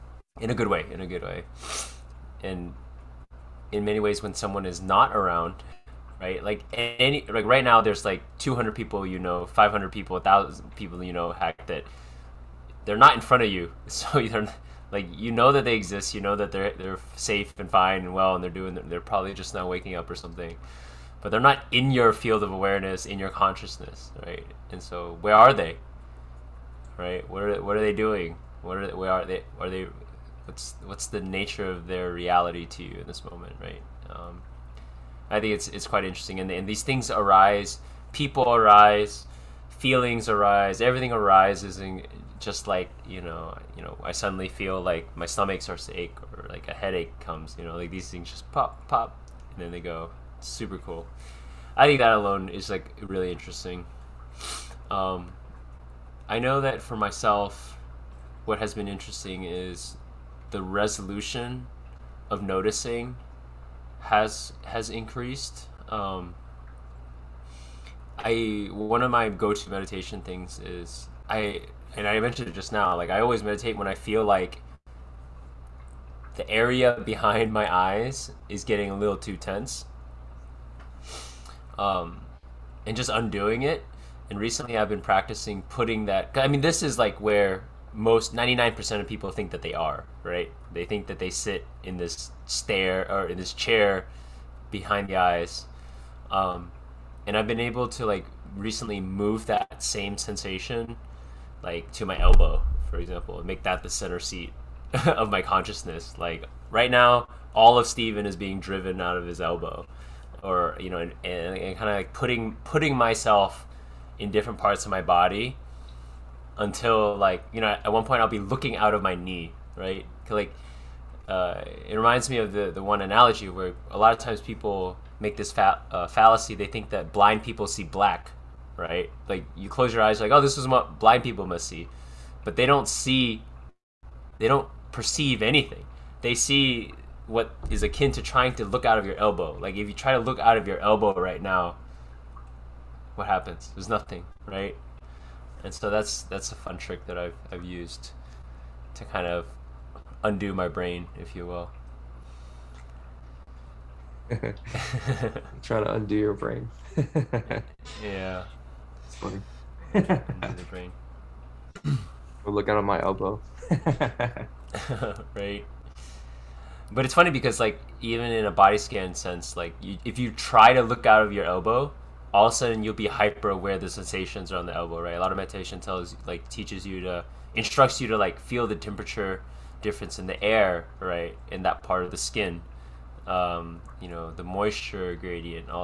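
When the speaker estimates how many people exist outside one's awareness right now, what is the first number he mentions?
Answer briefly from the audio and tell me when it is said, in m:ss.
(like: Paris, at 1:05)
200, at 0:08.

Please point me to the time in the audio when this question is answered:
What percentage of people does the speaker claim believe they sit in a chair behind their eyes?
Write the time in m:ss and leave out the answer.
1:28.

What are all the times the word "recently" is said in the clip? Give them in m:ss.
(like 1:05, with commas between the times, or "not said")
1:24, 1:38.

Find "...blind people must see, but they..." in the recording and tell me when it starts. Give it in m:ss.
2:10.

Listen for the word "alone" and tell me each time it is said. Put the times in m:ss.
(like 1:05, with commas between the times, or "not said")
0:52.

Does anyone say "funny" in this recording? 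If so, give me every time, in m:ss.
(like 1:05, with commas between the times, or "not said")
2:39, 2:47.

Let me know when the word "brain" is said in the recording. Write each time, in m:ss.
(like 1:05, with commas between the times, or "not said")
2:30, 2:36, 2:40.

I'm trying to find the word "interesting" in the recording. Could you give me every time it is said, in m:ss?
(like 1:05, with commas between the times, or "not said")
0:36, 0:53, 0:58.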